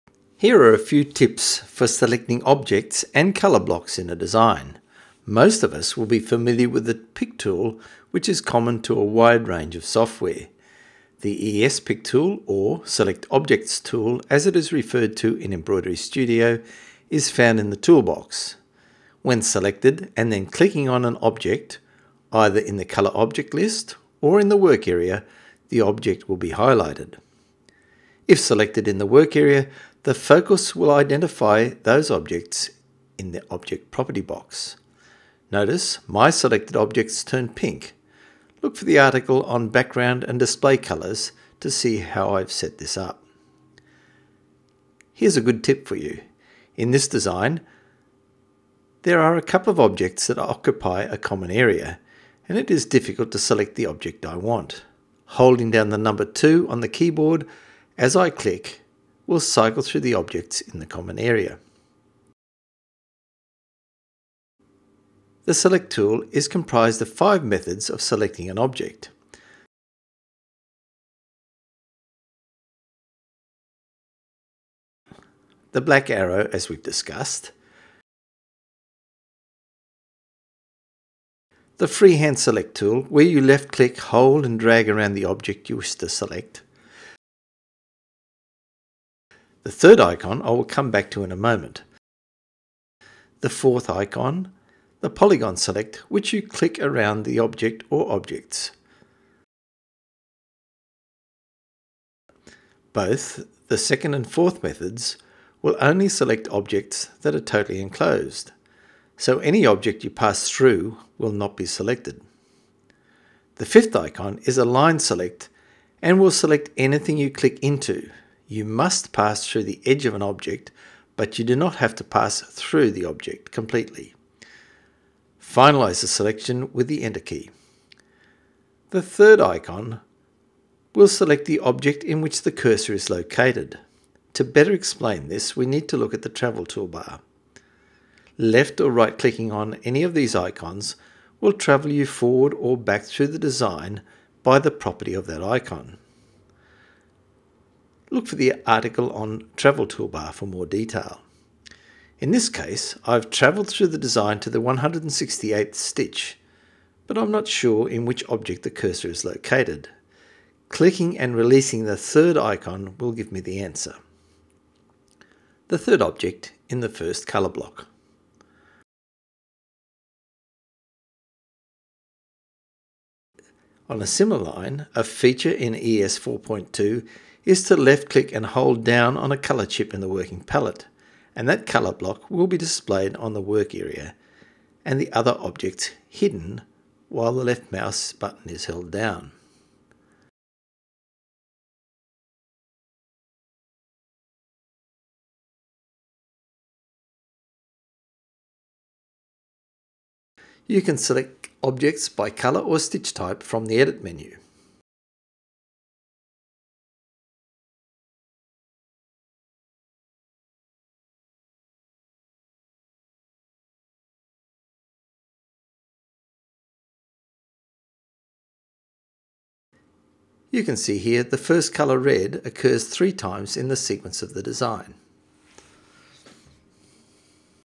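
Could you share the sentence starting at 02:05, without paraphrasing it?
Finalize the selection with the Enter key.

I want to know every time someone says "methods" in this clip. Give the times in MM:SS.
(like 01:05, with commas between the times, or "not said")
01:07, 01:44.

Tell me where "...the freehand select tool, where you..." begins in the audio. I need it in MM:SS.
01:21.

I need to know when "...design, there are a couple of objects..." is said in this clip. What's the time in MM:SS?
00:47.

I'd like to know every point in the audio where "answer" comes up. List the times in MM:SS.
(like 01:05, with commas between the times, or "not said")
02:43.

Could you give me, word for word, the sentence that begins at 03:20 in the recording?
You can select objects by color or stitch type from the edit menu.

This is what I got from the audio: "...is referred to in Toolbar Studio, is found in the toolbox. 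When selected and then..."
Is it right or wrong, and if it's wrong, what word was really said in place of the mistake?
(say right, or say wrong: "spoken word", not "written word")
wrong: "Embroidery", not "Toolbar".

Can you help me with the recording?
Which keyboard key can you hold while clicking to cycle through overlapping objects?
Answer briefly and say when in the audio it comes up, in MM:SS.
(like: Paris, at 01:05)
2, at 00:55.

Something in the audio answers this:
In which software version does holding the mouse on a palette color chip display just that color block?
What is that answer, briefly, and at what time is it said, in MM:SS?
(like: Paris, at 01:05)
ES 4.2, at 02:55.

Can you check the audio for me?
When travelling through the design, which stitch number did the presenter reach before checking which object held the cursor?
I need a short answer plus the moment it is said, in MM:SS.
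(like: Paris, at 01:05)
168, at 02:34.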